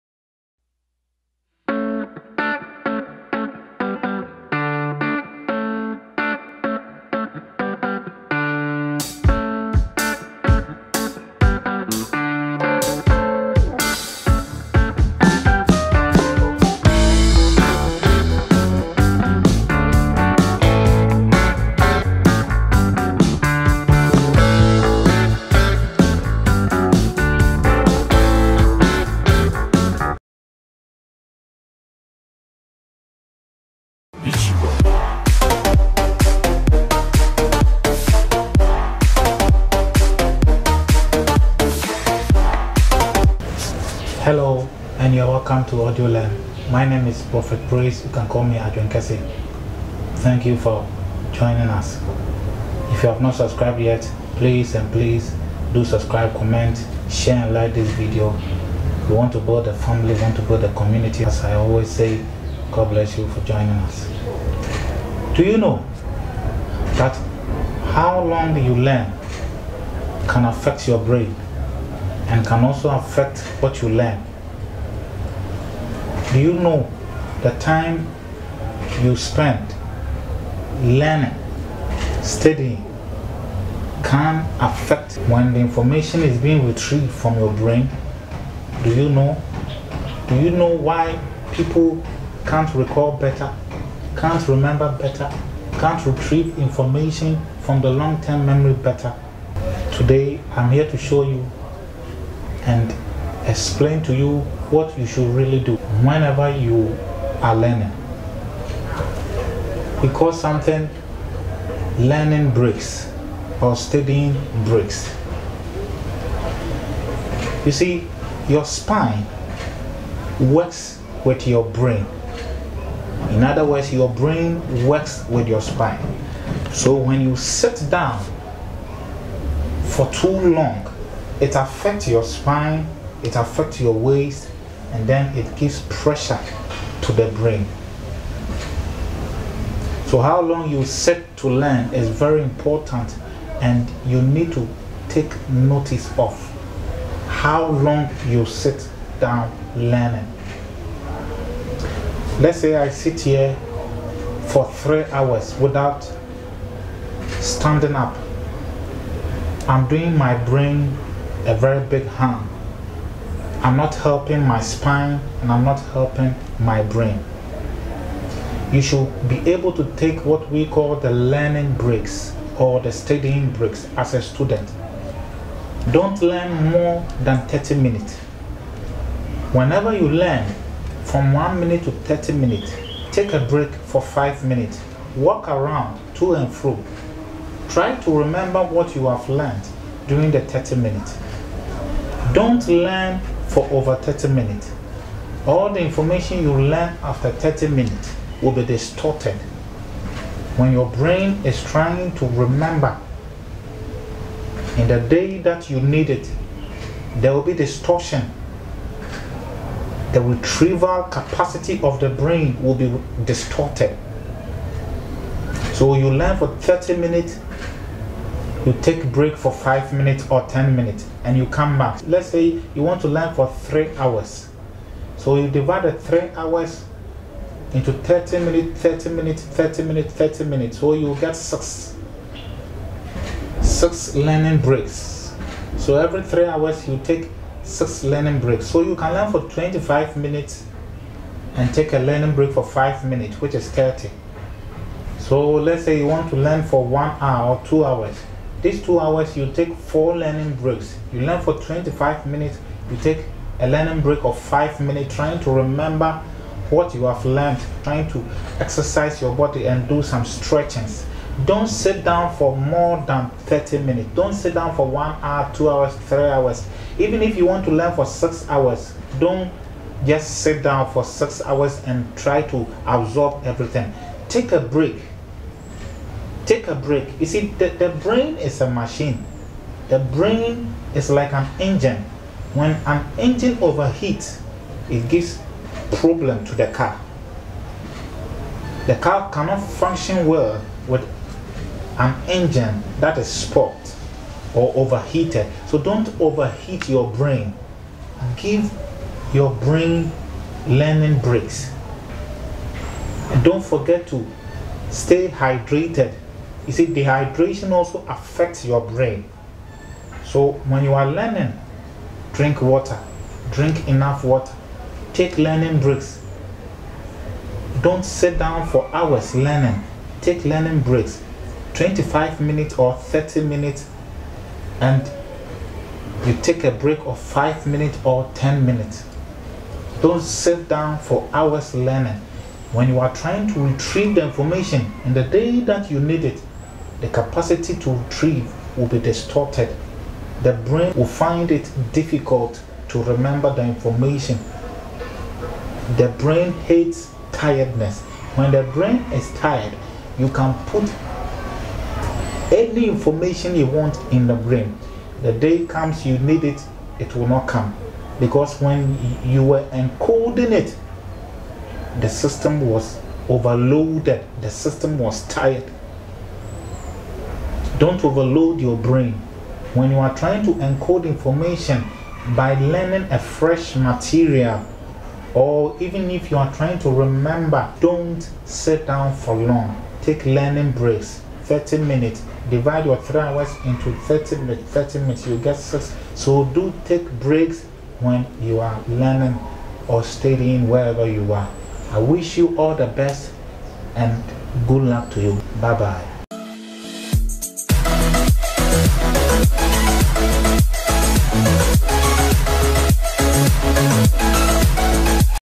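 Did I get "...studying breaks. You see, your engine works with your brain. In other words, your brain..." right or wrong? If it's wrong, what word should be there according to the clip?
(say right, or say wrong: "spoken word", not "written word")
wrong: "spine", not "engine".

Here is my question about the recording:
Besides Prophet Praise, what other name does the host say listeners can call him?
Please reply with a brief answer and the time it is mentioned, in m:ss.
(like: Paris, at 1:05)
Adrian Kese, at 0:48.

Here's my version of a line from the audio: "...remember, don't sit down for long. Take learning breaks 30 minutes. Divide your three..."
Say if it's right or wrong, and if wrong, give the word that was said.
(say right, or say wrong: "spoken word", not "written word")
right.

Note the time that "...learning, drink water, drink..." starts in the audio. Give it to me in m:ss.
5:11.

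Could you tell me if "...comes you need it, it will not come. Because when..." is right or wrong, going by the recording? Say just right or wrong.
right.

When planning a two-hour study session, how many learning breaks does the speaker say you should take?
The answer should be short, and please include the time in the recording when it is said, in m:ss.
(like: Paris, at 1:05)
4, at 4:09.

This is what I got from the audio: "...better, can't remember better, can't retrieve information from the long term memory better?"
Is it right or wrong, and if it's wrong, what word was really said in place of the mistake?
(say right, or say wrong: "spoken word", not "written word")
right.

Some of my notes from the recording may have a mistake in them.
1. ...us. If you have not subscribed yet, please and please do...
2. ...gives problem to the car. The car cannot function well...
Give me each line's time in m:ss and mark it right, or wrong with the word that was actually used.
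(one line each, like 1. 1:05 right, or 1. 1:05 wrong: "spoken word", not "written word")
1. 0:51 right
2. 4:45 right.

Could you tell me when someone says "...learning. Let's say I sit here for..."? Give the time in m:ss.
2:29.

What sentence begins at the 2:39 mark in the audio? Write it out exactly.
I'm doing my brain a very big harm.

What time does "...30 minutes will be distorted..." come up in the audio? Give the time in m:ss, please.
3:17.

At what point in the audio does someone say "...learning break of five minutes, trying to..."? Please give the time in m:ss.
4:13.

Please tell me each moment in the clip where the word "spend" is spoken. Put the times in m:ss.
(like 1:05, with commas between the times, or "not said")
1:19.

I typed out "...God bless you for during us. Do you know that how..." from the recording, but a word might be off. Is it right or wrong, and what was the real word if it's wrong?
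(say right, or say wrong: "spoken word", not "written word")
wrong: "joining", not "during".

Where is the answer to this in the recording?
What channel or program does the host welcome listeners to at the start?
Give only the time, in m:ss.
0:45.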